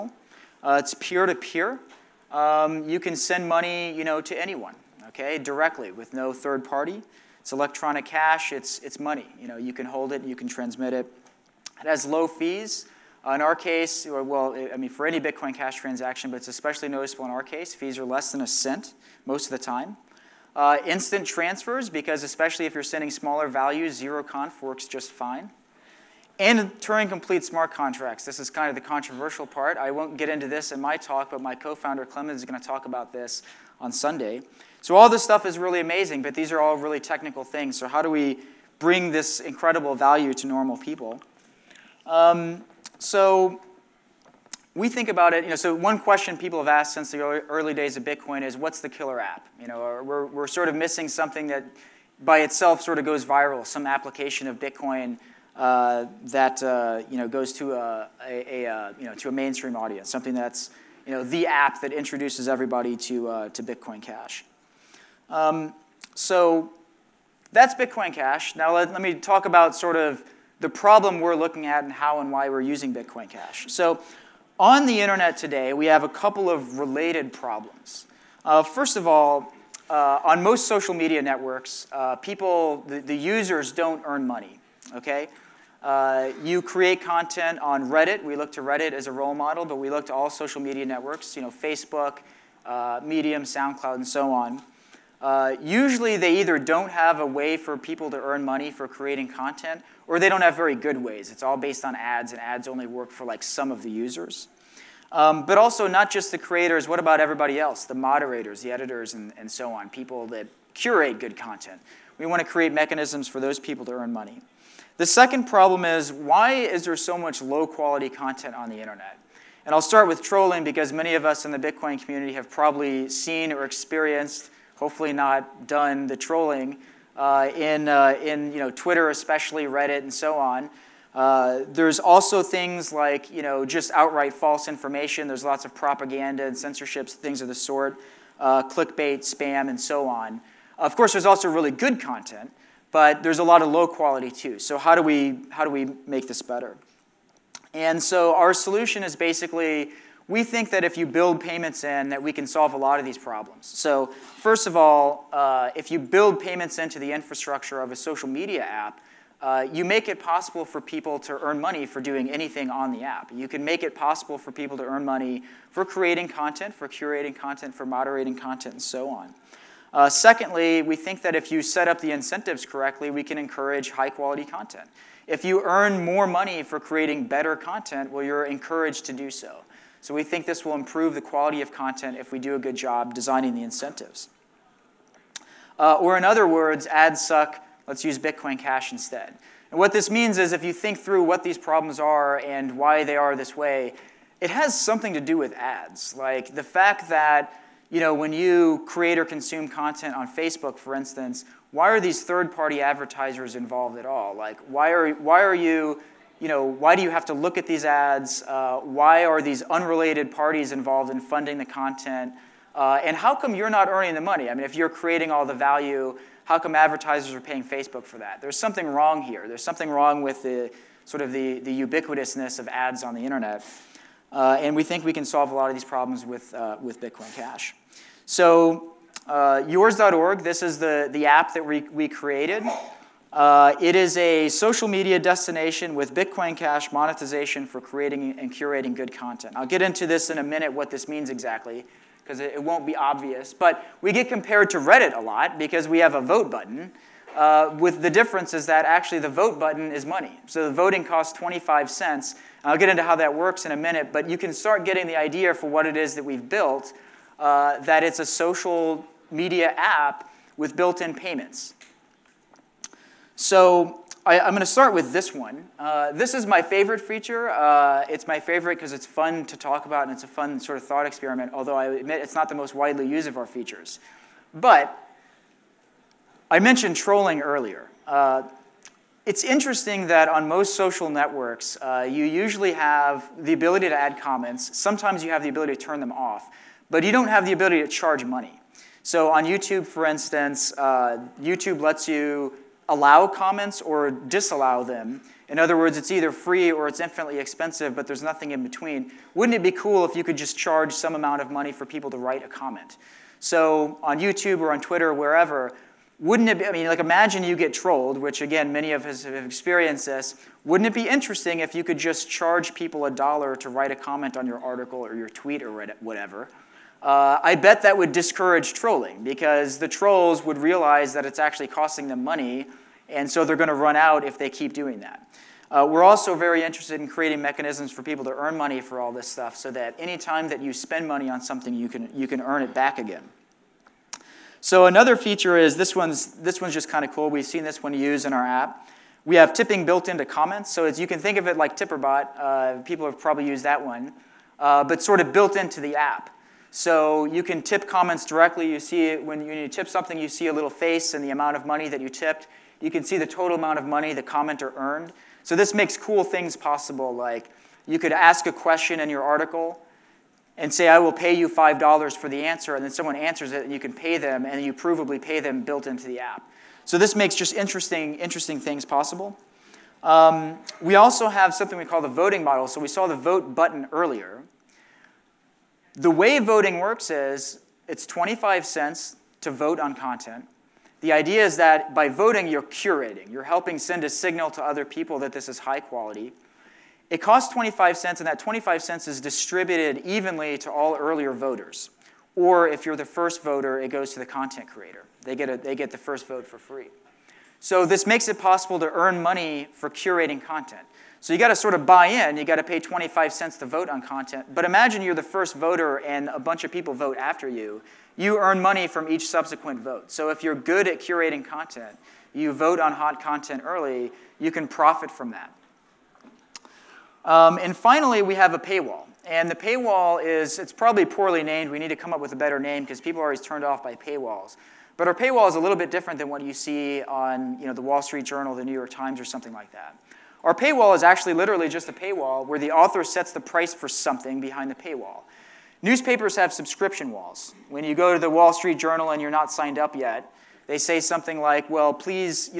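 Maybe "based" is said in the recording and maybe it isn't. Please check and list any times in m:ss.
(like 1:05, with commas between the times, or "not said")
1:41.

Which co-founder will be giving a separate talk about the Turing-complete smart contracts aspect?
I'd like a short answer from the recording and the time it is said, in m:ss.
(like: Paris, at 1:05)
Clemens, at 0:32.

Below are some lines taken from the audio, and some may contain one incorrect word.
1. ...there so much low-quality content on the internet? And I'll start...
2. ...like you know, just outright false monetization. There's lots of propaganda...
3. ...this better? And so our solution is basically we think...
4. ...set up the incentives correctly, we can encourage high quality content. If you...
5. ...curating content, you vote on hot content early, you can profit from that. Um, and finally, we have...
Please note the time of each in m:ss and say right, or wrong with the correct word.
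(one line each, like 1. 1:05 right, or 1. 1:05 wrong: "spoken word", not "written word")
1. 1:56 right
2. 2:12 wrong: "information", not "monetization"
3. 2:26 right
4. 2:51 right
5. 6:50 right.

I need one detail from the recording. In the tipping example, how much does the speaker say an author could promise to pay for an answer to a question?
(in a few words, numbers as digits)
$5.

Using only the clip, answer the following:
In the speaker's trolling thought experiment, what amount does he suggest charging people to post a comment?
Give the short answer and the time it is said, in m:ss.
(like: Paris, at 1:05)
$1, at 5:13.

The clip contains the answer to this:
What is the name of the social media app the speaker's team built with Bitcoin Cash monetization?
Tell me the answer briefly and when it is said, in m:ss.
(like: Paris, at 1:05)
yours.org, at 3:49.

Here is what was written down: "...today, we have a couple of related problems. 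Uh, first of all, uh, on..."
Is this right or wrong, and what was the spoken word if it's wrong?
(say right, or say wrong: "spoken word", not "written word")
right.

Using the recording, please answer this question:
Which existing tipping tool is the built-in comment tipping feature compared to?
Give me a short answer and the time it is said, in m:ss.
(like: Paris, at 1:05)
Tipperbot, at 5:41.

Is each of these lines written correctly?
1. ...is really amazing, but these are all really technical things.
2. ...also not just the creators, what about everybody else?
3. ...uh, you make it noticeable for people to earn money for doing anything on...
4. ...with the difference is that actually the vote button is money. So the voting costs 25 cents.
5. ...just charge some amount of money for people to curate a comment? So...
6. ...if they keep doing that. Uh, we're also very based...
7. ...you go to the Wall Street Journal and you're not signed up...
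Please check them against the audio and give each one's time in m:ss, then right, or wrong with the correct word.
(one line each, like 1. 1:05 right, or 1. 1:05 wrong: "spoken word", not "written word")
1. 0:35 right
2. 1:45 right
3. 2:39 wrong: "possible", not "noticeable"
4. 4:07 right
5. 5:00 wrong: "write", not "curate"
6. 5:24 wrong: "interested", not "based"
7. 7:17 right.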